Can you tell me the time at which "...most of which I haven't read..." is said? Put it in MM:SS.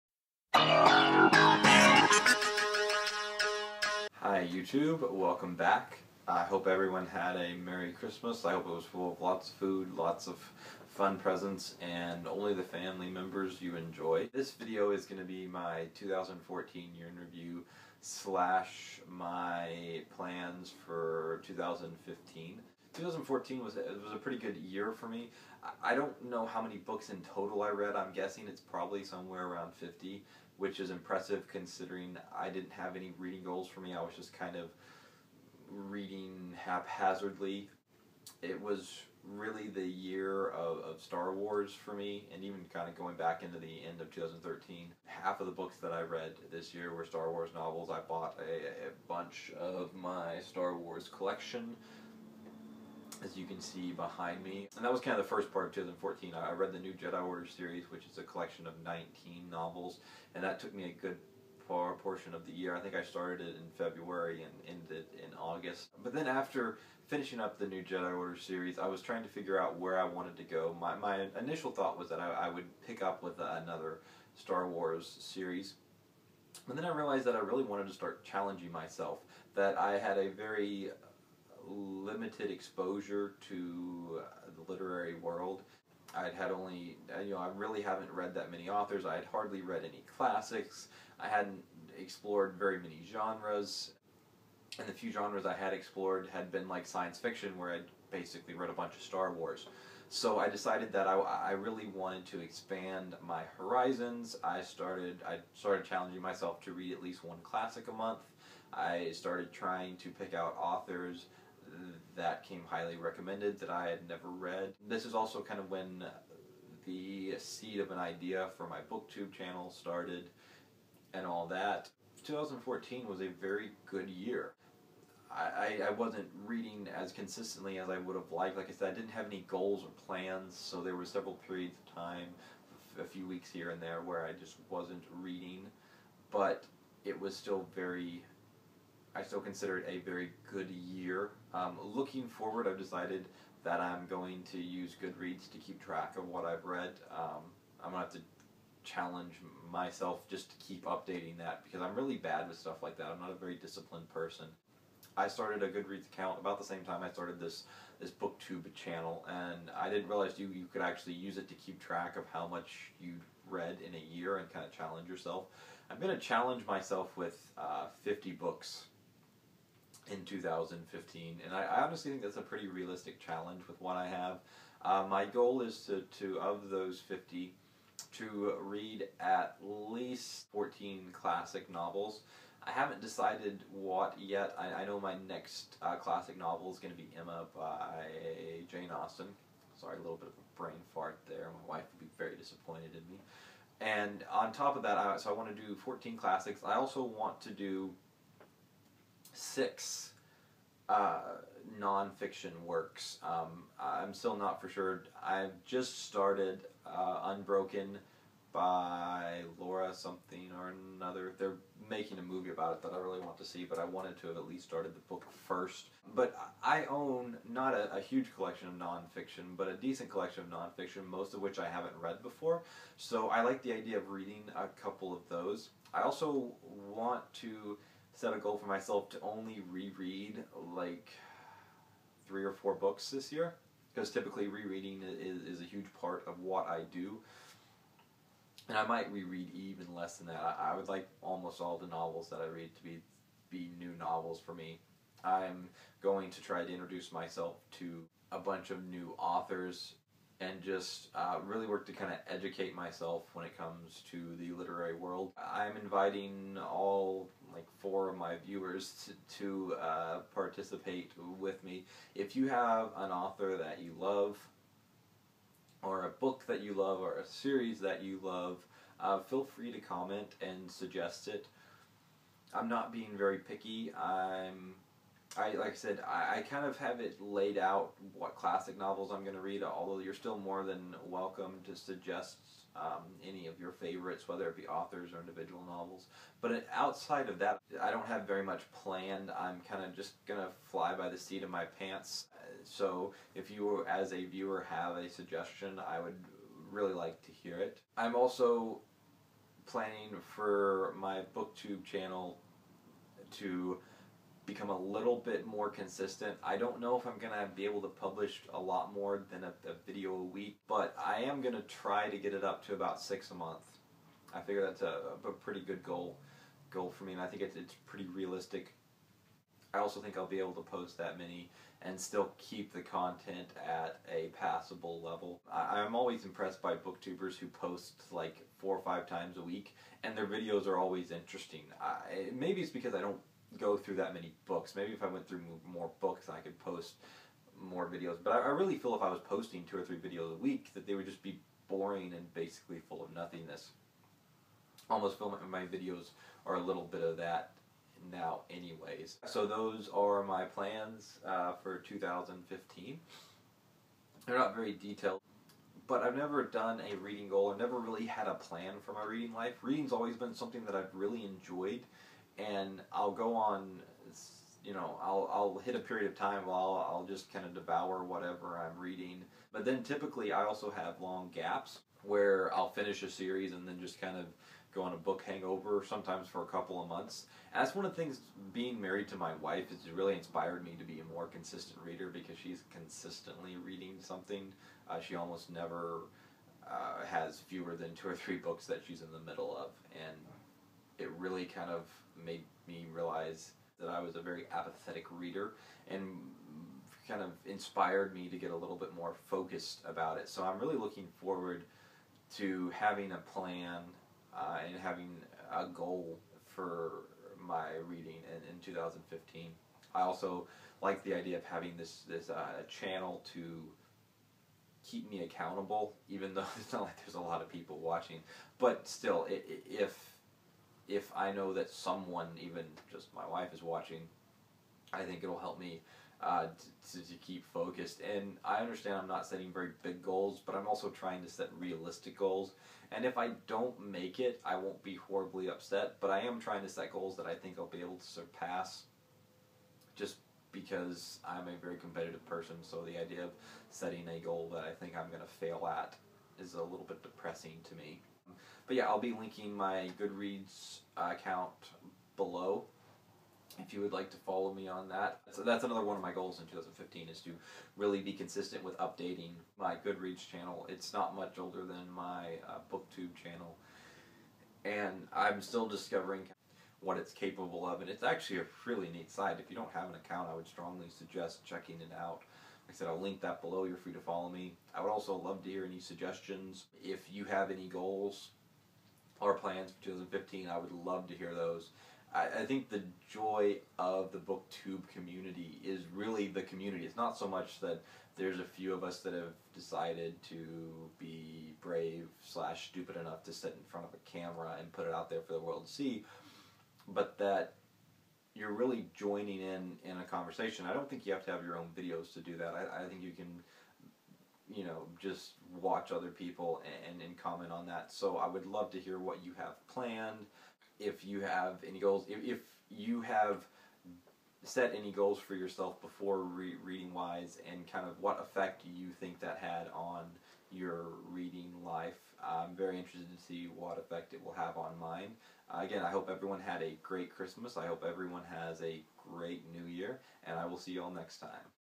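03:41.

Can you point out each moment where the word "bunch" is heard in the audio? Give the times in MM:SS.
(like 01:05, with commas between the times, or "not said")
00:49, 01:38, 04:08.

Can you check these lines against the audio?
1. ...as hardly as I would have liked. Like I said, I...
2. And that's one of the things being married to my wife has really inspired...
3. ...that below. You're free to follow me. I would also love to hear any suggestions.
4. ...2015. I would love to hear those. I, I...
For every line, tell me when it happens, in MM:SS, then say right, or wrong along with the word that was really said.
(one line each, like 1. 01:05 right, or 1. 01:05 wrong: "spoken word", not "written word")
1. 02:06 wrong: "consistently", not "hardly"
2. 06:17 right
3. 07:53 right
4. 07:59 right.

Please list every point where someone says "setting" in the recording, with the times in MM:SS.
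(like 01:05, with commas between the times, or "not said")
07:09, 07:23.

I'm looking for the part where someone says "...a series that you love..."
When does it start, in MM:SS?
04:27.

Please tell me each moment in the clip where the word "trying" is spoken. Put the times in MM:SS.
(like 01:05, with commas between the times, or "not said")
01:09, 01:49, 07:10, 07:16.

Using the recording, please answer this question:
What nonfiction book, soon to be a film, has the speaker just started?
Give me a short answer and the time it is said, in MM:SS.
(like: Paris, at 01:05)
Unbroken, at 03:27.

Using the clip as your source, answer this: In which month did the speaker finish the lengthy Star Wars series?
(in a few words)
August.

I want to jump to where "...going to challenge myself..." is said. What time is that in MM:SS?
02:45.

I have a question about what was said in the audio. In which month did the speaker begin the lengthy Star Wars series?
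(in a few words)
February.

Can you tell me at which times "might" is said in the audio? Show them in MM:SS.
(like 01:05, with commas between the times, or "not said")
03:58.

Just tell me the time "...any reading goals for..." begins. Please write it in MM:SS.
00:32.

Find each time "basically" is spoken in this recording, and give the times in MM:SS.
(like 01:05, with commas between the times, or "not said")
01:38, 05:42.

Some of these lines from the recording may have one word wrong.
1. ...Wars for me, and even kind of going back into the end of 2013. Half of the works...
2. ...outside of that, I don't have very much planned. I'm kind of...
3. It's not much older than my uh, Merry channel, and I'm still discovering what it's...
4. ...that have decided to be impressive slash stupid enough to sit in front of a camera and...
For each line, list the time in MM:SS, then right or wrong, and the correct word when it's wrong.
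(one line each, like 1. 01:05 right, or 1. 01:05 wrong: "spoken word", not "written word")
1. 00:41 wrong: "books", not "works"
2. 04:46 right
3. 07:40 wrong: "BookTube", not "Merry"
4. 08:08 wrong: "brave", not "impressive".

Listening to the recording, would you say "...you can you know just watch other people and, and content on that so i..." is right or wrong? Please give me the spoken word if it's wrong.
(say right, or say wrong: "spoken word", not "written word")
wrong: "comment", not "content".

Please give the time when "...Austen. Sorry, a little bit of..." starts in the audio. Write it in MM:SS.
03:08.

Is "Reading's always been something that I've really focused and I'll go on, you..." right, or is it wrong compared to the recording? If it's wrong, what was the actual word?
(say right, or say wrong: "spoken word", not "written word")
wrong: "enjoyed", not "focused".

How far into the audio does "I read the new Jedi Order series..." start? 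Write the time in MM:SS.
00:56.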